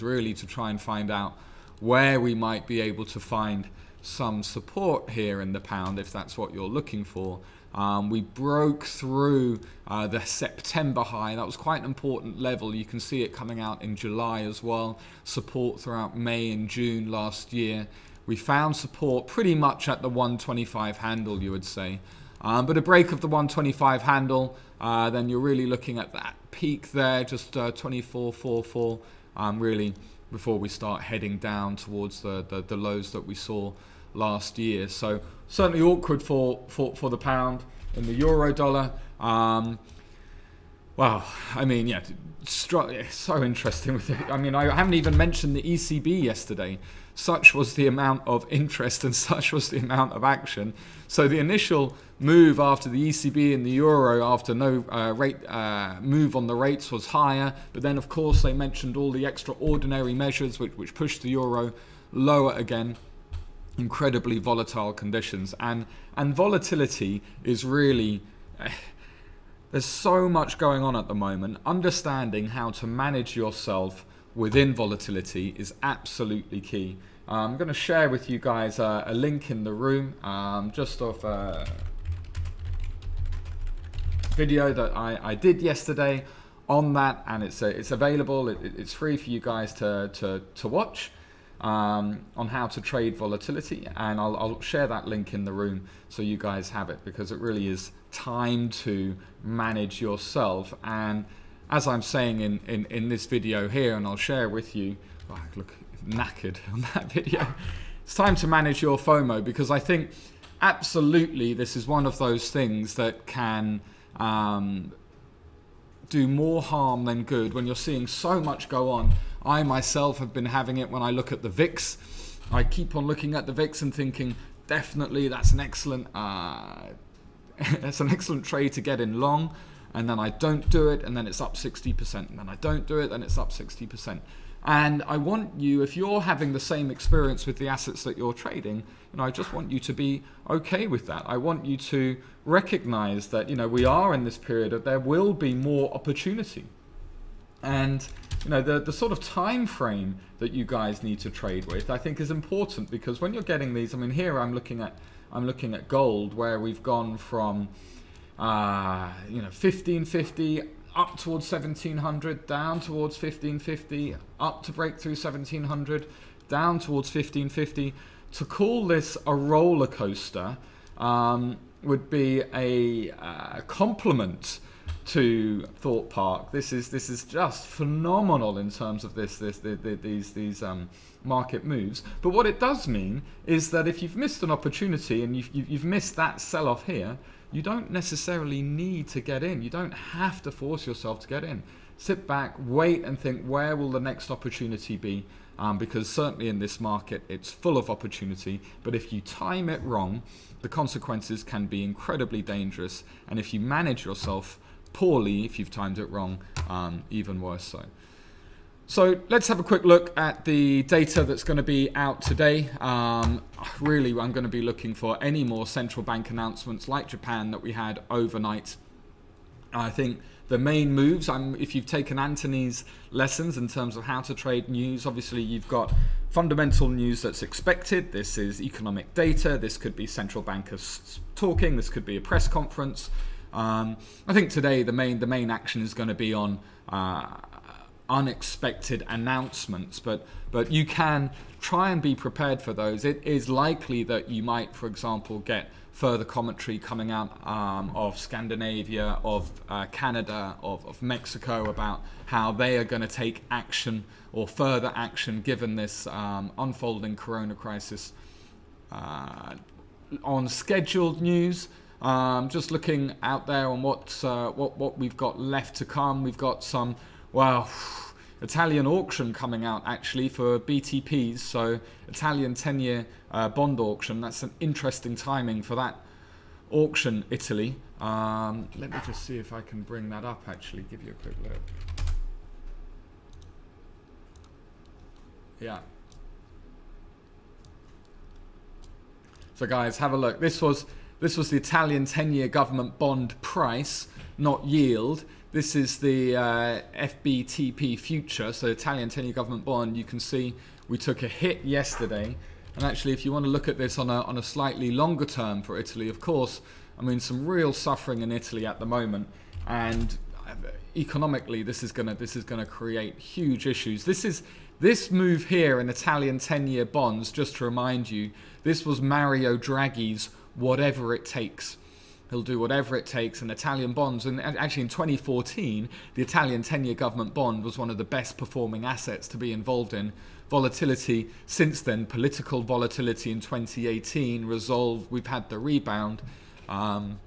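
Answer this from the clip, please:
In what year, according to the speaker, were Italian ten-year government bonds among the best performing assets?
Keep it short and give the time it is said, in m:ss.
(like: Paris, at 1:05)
2014, at 5:24.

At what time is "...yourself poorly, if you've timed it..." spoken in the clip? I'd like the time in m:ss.
3:24.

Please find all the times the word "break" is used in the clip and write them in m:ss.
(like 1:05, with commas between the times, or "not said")
0:22, 2:44.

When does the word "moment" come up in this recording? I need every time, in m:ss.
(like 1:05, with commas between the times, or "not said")
1:11, 5:08.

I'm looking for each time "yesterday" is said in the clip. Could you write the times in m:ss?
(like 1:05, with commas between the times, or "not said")
0:46, 1:25, 5:01.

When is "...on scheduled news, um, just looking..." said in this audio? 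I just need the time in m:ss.
4:20.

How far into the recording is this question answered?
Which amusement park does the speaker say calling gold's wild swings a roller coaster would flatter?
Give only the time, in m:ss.
2:55.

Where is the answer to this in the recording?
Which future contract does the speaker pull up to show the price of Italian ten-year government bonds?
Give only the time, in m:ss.
4:56.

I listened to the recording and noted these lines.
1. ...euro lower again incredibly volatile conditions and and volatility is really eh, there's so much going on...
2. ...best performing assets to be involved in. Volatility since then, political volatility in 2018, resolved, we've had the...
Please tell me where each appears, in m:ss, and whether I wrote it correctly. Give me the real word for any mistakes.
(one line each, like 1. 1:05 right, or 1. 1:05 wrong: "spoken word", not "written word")
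1. 1:01 right
2. 5:28 right.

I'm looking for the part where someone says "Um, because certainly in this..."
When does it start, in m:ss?
3:15.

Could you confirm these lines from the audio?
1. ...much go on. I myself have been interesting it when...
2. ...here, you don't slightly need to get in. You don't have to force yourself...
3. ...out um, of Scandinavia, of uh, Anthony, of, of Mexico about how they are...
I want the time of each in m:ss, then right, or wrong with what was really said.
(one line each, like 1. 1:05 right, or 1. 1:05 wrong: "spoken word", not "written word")
1. 1:58 wrong: "having", not "interesting"
2. 3:06 wrong: "necessarily", not "slightly"
3. 4:07 wrong: "Canada", not "Anthony".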